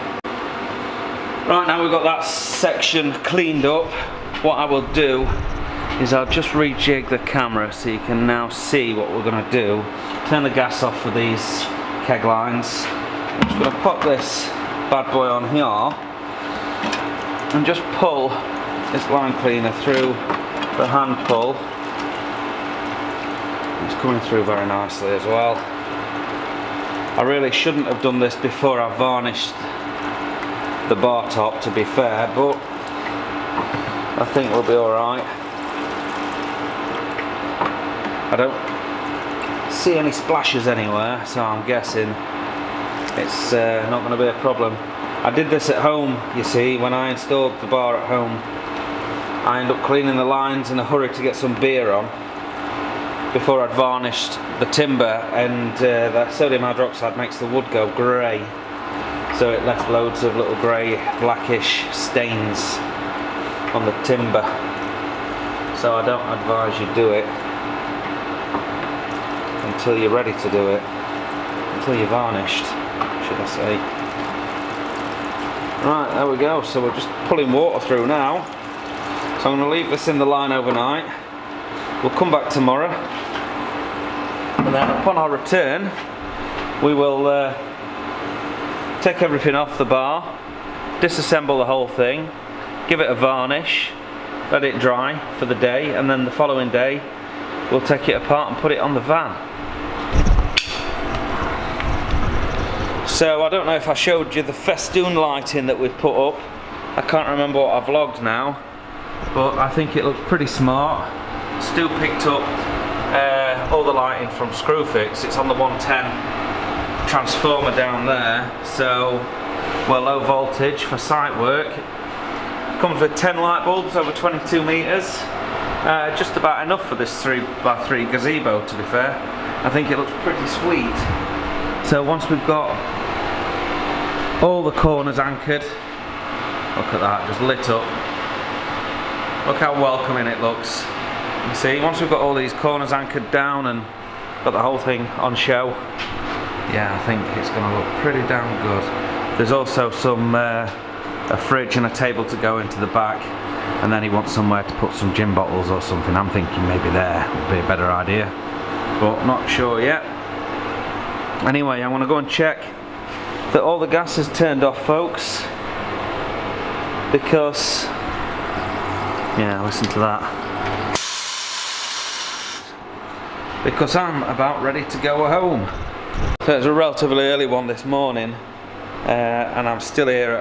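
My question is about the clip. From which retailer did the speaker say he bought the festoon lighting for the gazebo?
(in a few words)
Screwfix.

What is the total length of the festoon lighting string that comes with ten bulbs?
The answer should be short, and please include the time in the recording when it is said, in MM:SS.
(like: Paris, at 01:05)
22 meters, at 02:04.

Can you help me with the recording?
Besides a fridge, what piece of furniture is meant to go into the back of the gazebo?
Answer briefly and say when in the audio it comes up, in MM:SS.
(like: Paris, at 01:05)
a table, at 02:31.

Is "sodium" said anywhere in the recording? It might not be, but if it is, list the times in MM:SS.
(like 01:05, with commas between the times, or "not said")
00:56.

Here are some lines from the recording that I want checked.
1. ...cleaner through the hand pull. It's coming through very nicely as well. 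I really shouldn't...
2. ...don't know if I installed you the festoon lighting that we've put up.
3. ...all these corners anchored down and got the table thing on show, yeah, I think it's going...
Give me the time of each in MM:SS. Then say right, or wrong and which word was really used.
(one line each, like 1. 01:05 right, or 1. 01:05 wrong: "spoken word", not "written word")
1. 00:19 right
2. 01:43 wrong: "showed", not "installed"
3. 02:22 wrong: "whole", not "table".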